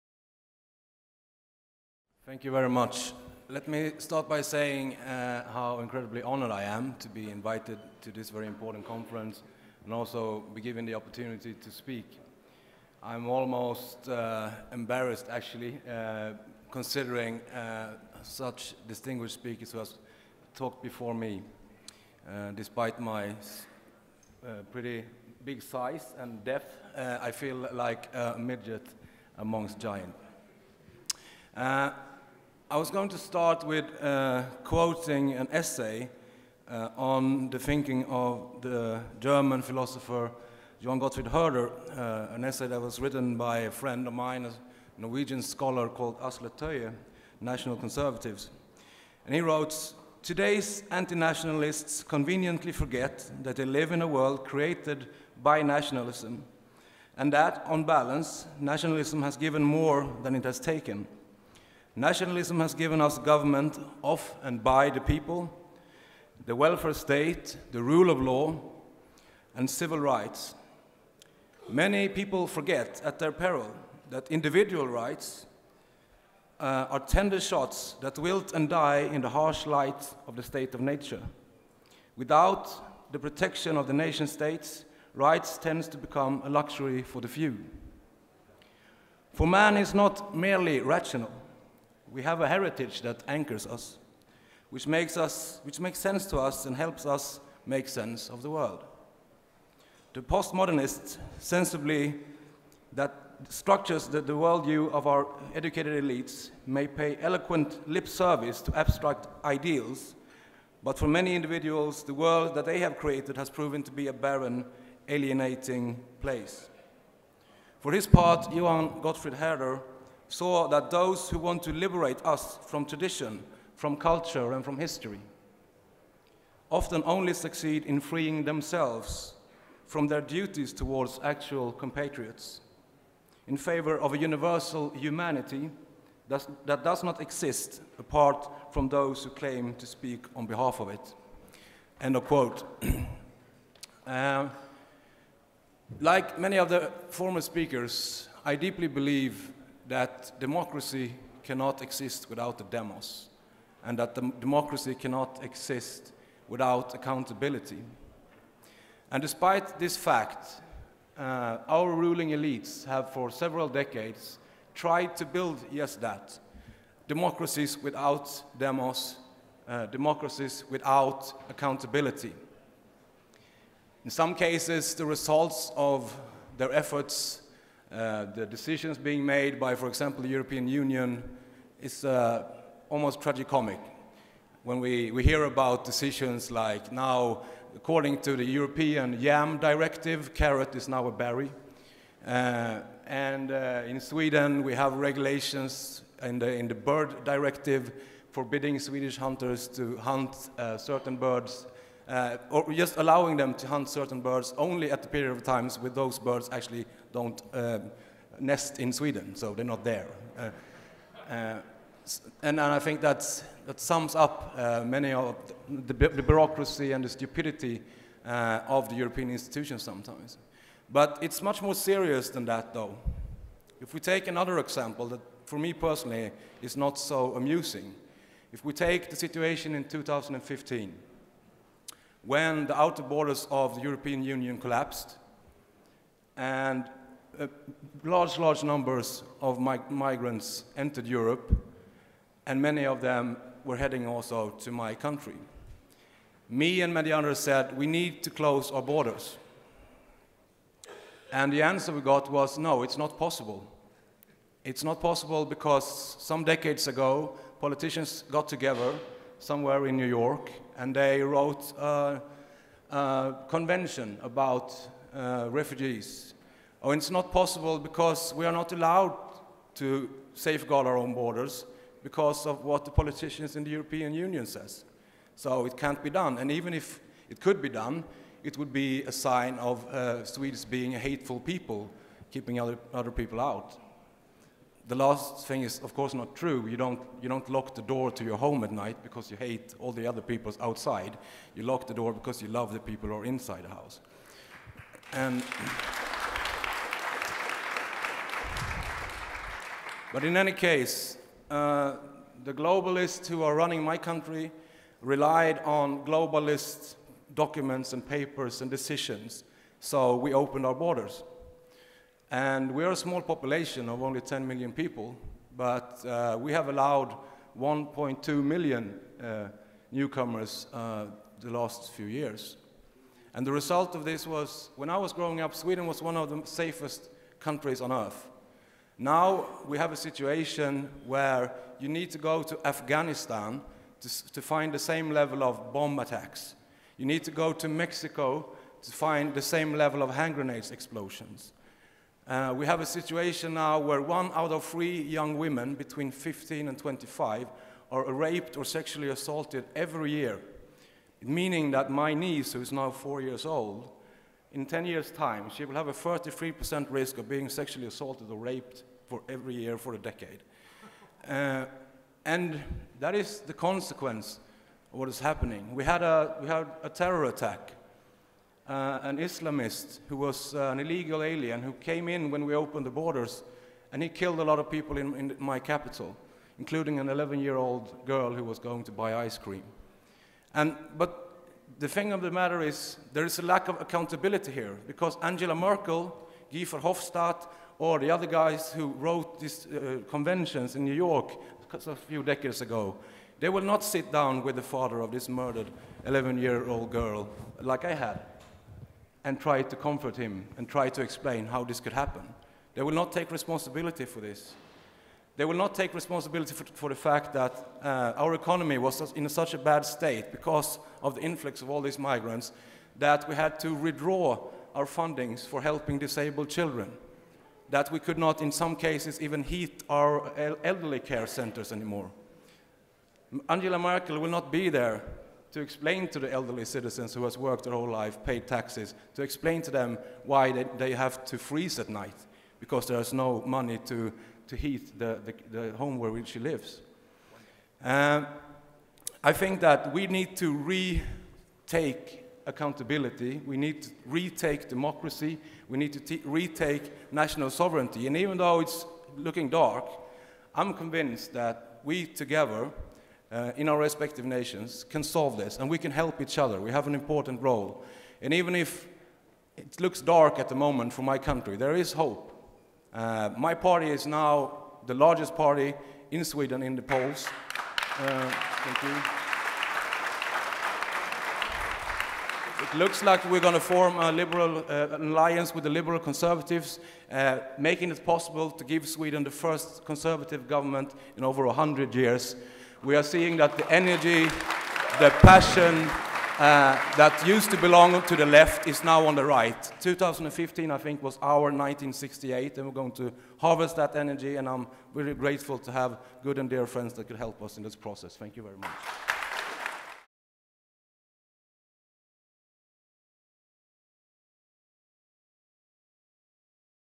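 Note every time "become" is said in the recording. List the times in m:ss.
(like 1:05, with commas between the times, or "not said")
1:25.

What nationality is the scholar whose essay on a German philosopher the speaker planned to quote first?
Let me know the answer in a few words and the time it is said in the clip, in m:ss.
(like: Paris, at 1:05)
Norwegian, at 0:44.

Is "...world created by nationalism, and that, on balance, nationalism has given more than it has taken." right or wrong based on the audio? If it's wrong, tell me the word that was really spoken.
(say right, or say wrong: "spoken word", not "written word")
right.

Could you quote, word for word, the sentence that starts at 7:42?
Uh, my party is now the largest party in Sweden in the polls.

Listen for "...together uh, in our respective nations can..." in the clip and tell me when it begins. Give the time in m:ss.
7:32.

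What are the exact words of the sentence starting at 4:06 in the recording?
Me and many others said, we need to close our borders.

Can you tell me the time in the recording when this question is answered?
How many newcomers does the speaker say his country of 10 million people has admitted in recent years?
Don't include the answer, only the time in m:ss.
5:17.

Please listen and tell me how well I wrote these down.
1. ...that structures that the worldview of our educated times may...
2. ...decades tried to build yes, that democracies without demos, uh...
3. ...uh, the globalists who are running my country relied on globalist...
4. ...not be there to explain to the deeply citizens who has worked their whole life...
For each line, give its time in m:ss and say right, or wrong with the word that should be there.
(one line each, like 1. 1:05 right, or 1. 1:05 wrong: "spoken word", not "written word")
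1. 1:42 wrong: "elites", not "times"
2. 2:43 right
3. 5:01 right
4. 7:04 wrong: "elderly", not "deeply".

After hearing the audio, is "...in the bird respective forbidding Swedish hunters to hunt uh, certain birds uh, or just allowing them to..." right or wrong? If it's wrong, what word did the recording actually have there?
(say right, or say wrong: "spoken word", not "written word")
wrong: "directive", not "respective".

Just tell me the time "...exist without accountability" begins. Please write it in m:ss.
2:35.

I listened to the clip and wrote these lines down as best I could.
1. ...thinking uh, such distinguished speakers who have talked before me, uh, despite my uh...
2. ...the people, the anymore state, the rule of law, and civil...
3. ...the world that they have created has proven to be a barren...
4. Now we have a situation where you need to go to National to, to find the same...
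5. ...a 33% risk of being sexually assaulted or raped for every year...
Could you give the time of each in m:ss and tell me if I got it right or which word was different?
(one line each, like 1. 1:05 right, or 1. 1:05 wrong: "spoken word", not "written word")
1. 0:16 wrong: "considering", not "thinking"
2. 1:04 wrong: "welfare", not "anymore"
3. 1:52 right
4. 5:28 wrong: "Afghanistan", not "National"
5. 5:55 right.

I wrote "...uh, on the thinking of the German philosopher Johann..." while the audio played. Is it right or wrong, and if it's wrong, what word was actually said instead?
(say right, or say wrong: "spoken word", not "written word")
right.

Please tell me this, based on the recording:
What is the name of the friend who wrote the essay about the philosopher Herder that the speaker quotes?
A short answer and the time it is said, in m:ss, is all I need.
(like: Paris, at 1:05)
Asle Toje, at 0:46.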